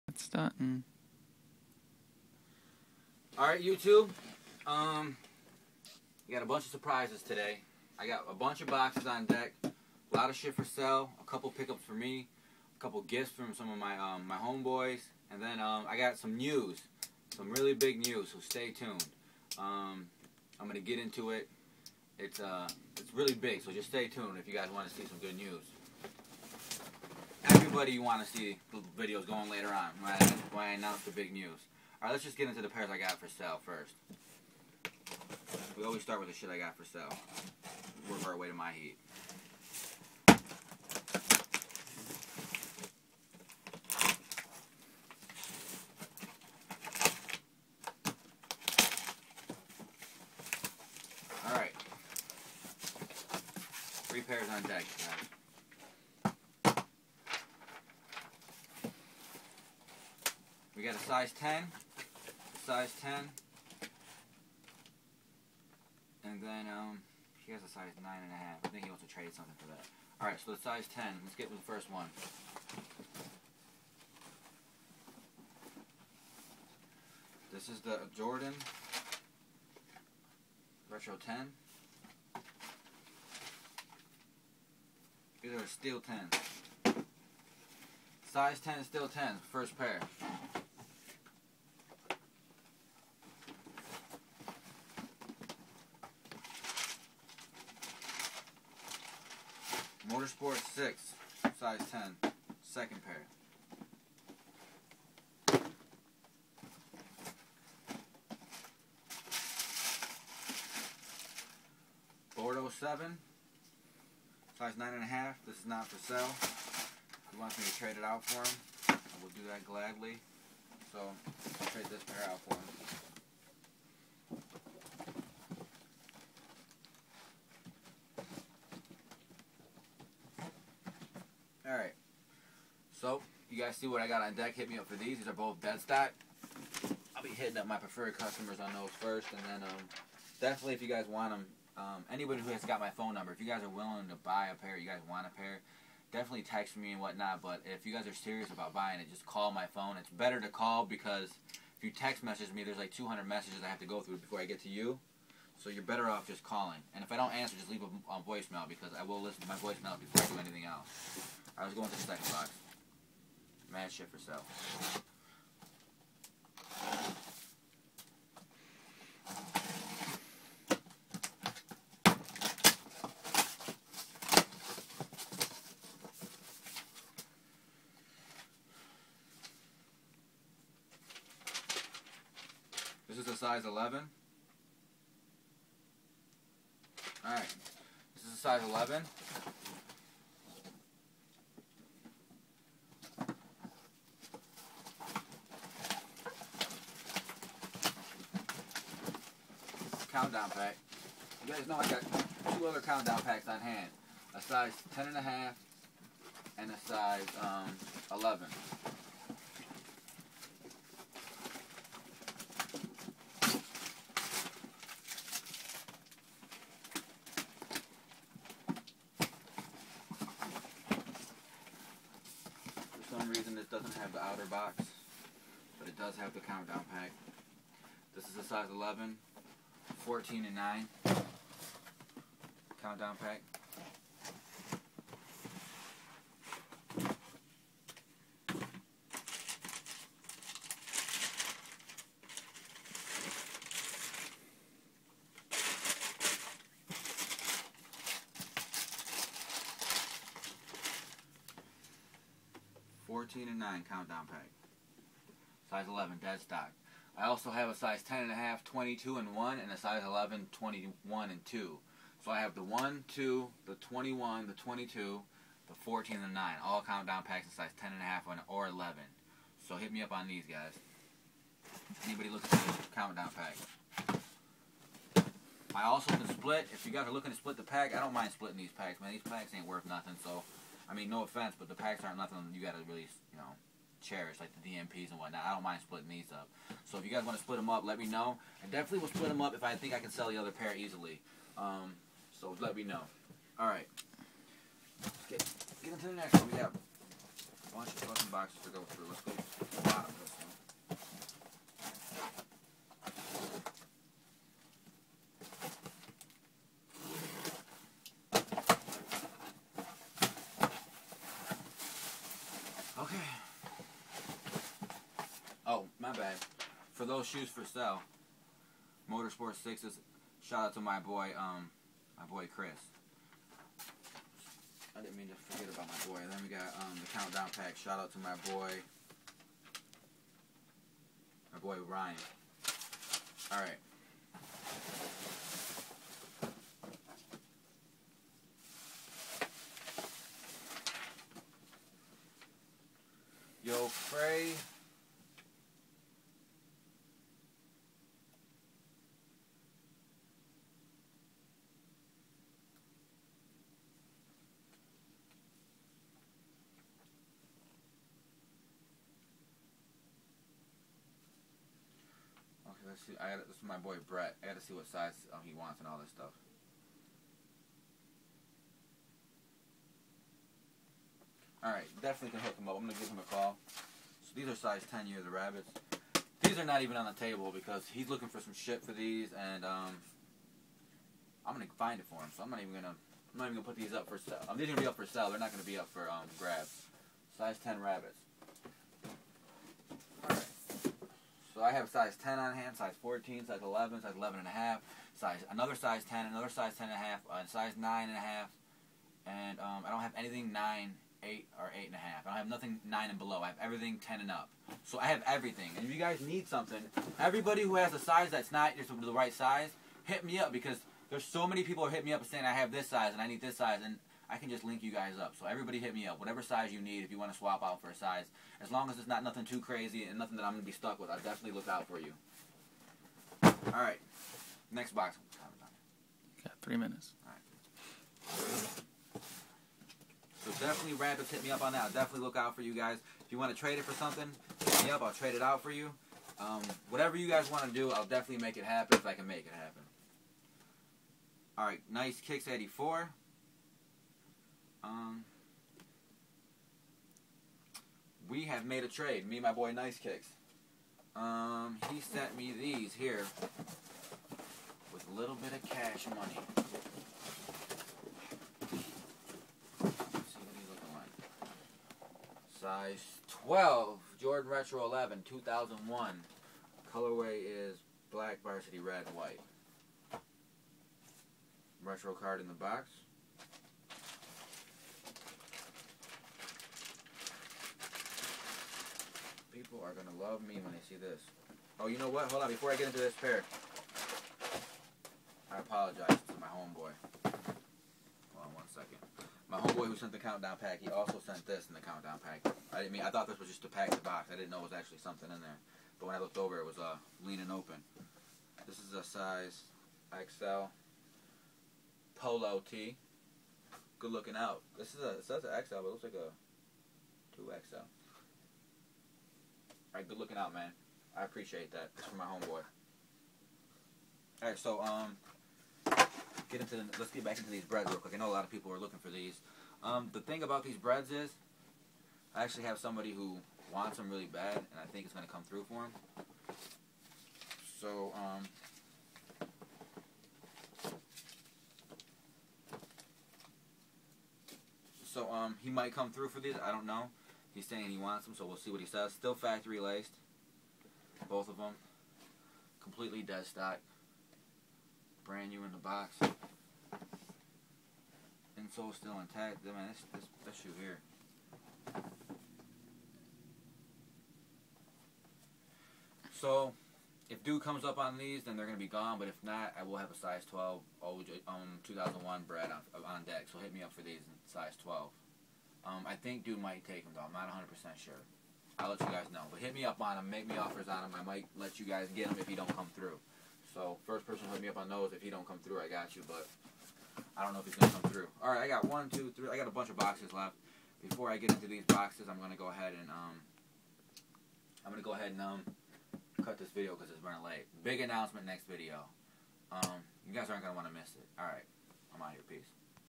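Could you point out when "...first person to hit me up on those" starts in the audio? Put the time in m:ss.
9:34.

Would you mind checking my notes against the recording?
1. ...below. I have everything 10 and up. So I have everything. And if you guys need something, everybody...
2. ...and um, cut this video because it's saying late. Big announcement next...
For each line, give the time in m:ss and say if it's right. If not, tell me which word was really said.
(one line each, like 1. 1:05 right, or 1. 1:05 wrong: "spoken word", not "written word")
1. 6:43 right
2. 9:45 wrong: "running", not "saying".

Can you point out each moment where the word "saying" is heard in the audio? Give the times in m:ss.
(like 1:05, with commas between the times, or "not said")
6:52, 8:57.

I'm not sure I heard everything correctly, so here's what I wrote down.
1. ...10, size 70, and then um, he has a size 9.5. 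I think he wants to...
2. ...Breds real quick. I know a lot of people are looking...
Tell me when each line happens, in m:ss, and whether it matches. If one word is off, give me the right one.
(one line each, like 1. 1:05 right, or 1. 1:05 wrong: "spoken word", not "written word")
1. 1:01 wrong: "10", not "70"
2. 8:37 right.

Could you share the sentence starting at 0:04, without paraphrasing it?
Um, got a bunch of surprises today.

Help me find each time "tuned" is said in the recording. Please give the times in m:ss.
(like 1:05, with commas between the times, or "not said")
0:18, 0:24.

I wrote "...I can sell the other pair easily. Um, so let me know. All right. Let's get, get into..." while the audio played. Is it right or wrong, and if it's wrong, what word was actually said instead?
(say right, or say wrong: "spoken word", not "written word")
right.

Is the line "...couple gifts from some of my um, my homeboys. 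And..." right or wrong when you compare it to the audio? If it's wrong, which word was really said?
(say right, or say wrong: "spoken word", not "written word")
right.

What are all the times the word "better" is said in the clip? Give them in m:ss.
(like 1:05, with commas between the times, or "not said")
2:30, 2:35.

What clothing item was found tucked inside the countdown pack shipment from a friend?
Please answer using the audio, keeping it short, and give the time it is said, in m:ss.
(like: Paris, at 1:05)
XL polo tee, at 8:20.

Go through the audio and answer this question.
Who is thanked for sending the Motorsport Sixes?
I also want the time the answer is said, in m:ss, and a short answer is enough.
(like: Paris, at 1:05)
Chris, at 5:22.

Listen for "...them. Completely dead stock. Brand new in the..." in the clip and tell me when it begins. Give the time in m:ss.
9:01.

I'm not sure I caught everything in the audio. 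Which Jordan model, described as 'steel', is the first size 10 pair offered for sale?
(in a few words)
Jordan Retro 10.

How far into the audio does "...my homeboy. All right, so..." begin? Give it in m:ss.
8:32.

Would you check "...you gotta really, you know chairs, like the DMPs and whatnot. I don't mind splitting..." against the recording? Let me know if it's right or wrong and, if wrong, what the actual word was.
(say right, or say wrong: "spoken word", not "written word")
right.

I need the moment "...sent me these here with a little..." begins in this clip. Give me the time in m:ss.
7:31.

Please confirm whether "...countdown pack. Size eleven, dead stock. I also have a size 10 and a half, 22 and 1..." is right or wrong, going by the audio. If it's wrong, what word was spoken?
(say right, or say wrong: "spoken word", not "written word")
right.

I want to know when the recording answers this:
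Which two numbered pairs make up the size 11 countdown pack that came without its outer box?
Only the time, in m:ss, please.
3:50.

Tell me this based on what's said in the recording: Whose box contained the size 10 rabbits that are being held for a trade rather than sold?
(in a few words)
Brett.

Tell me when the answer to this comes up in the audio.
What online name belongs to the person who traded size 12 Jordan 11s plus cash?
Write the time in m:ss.
7:21.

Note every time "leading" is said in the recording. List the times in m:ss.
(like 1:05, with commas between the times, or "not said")
not said.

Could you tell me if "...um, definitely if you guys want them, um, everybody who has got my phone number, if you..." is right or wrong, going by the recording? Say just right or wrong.
wrong.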